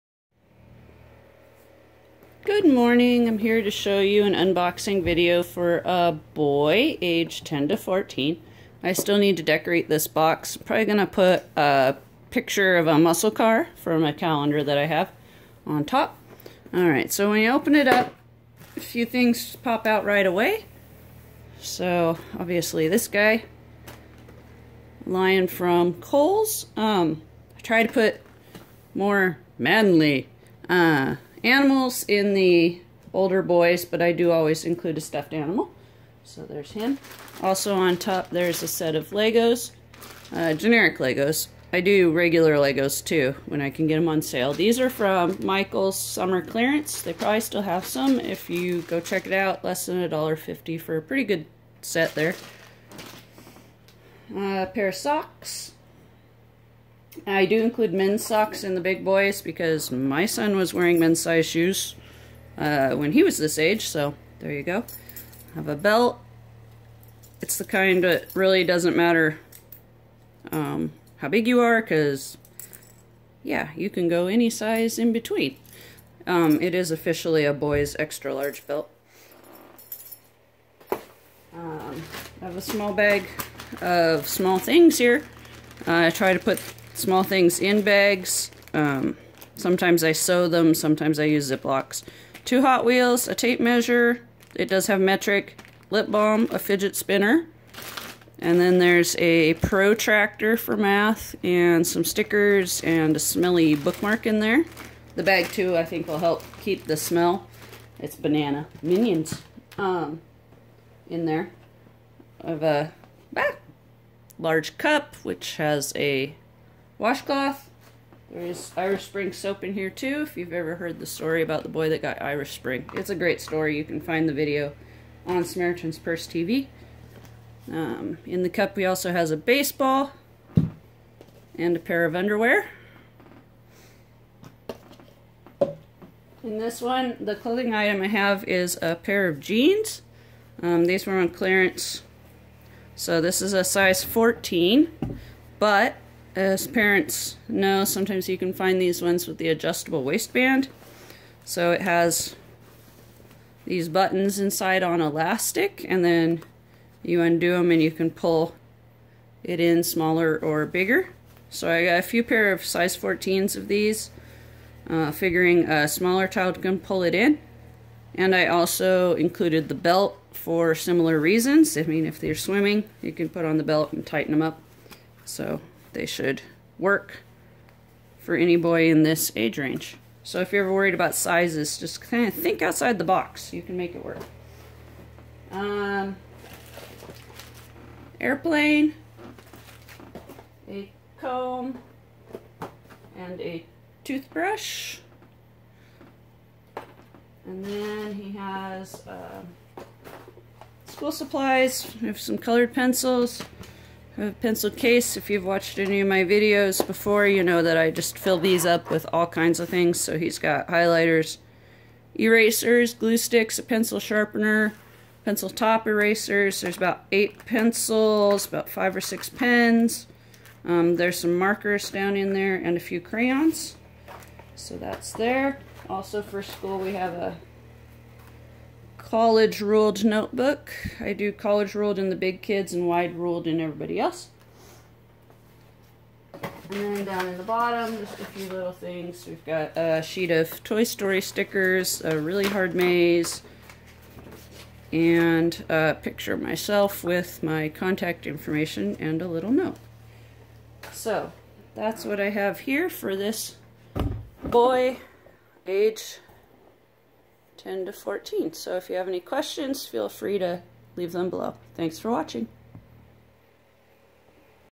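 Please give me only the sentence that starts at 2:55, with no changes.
So they should work for any boy in this age range.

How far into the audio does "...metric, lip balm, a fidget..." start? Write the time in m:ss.
1:35.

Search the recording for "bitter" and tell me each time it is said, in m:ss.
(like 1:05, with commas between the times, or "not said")
not said.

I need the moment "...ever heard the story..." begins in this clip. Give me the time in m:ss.
2:00.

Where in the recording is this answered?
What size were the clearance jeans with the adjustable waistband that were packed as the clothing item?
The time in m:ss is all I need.
2:23.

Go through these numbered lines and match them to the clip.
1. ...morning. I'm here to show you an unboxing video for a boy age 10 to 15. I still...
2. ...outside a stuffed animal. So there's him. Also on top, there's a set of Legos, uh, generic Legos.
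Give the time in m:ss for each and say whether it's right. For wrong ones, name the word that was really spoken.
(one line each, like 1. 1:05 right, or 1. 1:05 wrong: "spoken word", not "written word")
1. 0:02 wrong: "14", not "15"
2. 0:34 wrong: "include", not "outside".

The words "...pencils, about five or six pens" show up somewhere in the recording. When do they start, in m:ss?
3:37.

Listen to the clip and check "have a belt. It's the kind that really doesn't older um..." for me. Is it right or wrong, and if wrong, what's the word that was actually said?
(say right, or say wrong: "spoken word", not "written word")
wrong: "matter", not "older".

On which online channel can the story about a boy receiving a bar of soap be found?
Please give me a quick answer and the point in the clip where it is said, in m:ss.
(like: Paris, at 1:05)
Samaritan's Purse TV, at 2:05.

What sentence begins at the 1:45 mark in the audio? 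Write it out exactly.
The bag too, I think will help keep the smell.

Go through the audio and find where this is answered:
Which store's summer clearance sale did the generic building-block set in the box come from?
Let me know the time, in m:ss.
0:45.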